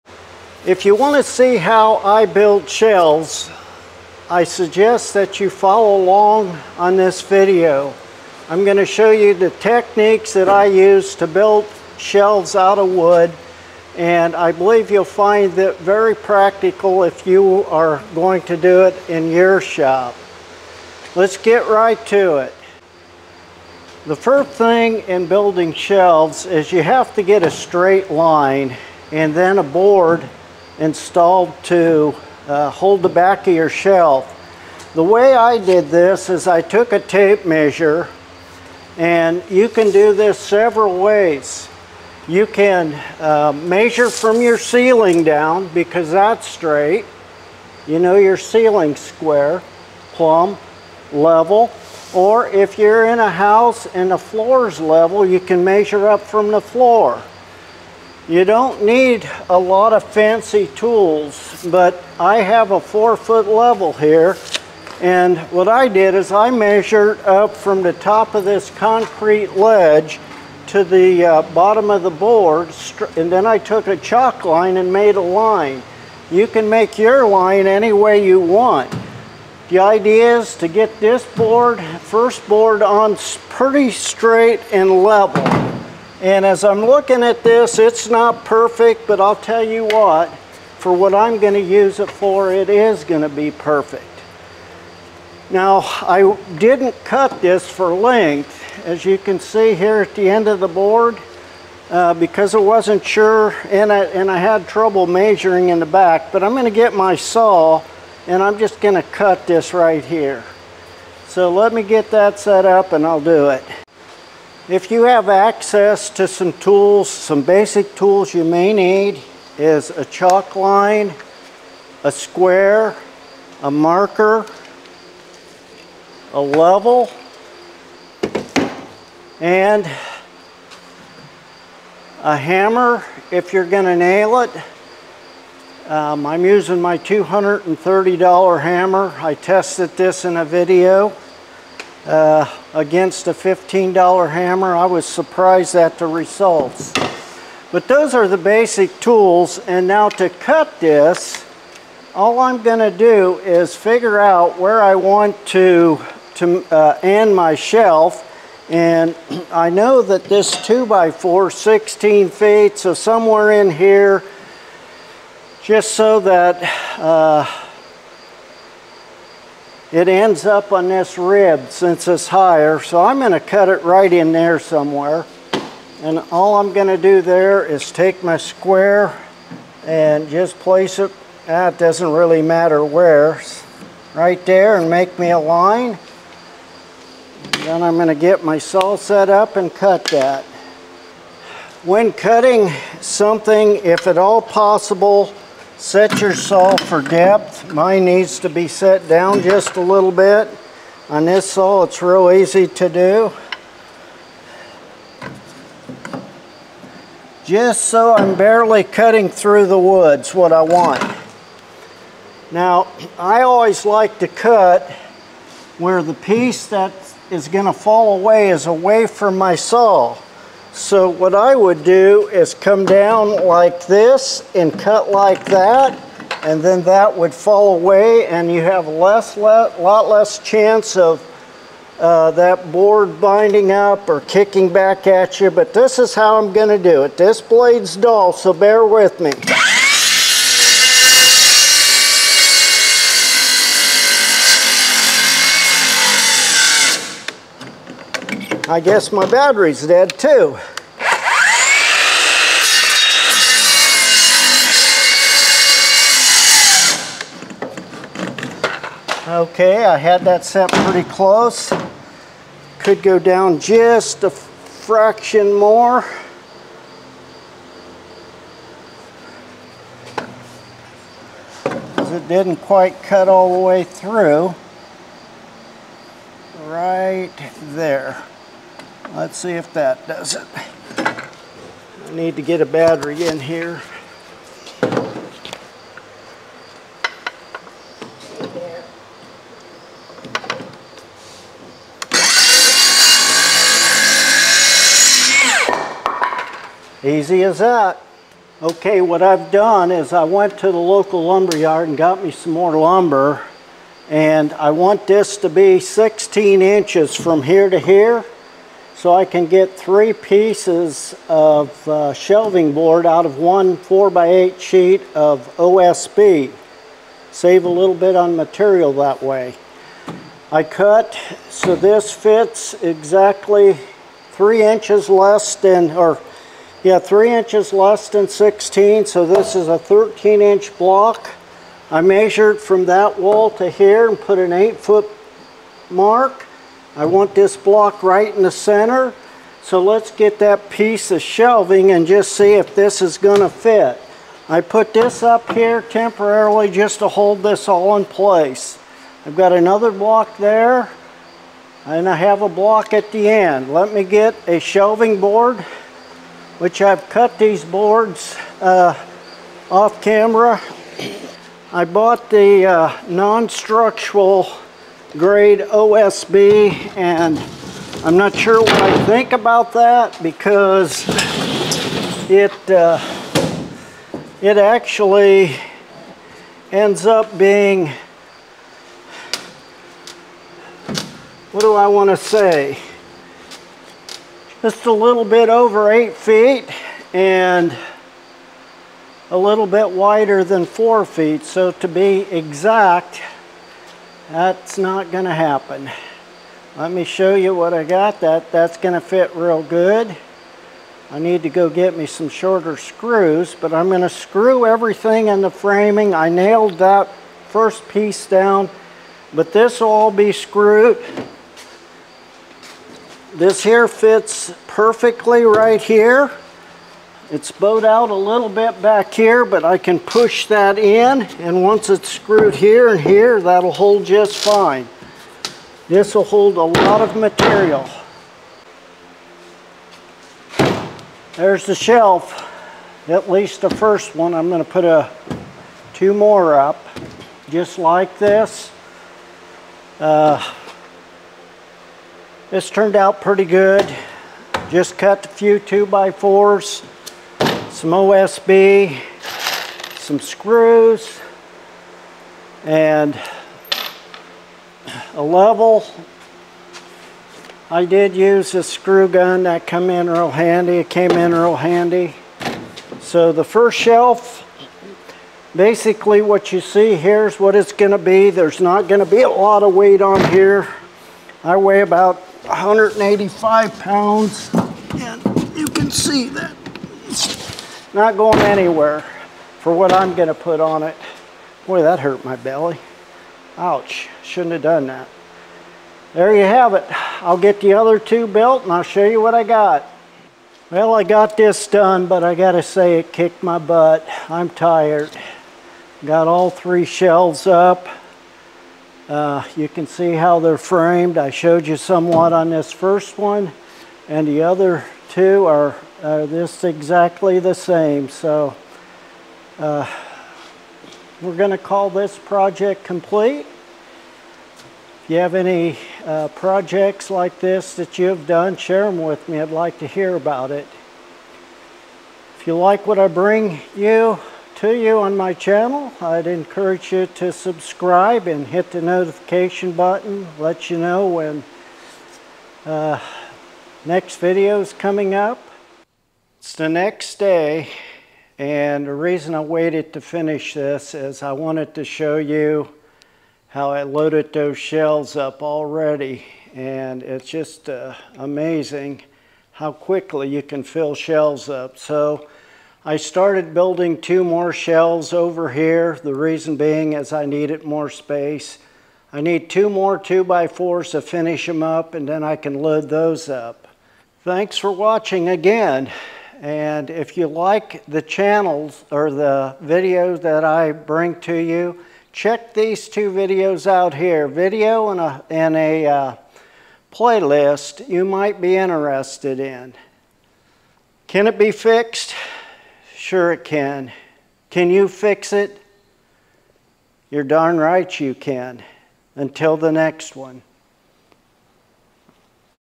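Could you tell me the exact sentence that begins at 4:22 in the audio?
Could go down just a fraction more.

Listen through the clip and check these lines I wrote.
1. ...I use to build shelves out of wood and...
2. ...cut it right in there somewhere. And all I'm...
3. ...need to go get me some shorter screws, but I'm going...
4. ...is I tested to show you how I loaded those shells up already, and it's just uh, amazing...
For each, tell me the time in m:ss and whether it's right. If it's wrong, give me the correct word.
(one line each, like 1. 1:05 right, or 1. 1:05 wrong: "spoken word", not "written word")
1. 0:10 right
2. 2:53 right
3. 6:41 right
4. 9:00 wrong: "wanted", not "tested".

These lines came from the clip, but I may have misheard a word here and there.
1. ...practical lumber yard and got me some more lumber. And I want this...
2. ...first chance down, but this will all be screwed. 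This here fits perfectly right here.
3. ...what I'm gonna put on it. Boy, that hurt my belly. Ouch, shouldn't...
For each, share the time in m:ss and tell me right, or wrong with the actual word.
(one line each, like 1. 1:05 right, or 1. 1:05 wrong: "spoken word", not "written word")
1. 5:00 wrong: "local", not "practical"
2. 6:47 wrong: "piece", not "chance"
3. 7:59 right.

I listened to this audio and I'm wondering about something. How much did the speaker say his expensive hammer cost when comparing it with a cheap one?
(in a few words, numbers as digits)
$230.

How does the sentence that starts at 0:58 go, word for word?
You don't need a lot of fancy tools, but I have a four foot level here.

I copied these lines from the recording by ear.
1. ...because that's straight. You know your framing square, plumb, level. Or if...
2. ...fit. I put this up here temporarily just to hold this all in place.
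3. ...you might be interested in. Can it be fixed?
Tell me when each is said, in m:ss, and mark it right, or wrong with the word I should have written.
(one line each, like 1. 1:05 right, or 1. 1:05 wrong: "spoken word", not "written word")
1. 0:45 wrong: "ceiling", not "framing"
2. 5:43 right
3. 9:37 right.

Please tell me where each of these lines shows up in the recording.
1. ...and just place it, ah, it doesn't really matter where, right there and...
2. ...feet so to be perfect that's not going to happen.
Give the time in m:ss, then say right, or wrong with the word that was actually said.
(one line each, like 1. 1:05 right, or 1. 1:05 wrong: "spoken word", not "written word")
1. 2:59 right
2. 6:31 wrong: "exact", not "perfect".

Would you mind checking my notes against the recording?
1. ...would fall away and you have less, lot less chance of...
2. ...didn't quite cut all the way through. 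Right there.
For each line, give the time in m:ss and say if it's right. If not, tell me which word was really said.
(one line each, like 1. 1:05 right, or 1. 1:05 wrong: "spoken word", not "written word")
1. 3:47 right
2. 4:32 right.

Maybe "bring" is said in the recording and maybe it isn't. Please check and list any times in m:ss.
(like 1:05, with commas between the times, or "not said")
8:43, 9:30.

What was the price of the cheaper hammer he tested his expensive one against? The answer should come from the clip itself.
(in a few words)
$15.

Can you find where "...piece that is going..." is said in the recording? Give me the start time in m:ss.
3:36.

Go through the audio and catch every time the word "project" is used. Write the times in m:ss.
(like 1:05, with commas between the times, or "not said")
8:32, 8:36.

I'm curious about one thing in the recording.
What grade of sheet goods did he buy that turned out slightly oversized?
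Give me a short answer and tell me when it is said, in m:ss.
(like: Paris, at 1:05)
non-structural grade, at 6:03.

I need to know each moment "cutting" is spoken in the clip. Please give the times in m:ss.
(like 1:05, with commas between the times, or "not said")
3:12, 3:28.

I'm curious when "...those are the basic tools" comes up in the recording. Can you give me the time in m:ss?
2:27.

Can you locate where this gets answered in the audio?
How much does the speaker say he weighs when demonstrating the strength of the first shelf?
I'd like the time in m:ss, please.
7:52.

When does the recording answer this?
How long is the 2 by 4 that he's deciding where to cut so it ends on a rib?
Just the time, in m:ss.
2:41.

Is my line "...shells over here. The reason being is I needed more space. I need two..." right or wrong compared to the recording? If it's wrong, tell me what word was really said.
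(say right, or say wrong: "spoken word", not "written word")
right.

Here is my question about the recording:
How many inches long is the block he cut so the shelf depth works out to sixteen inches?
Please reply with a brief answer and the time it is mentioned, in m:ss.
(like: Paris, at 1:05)
13 inches, at 5:29.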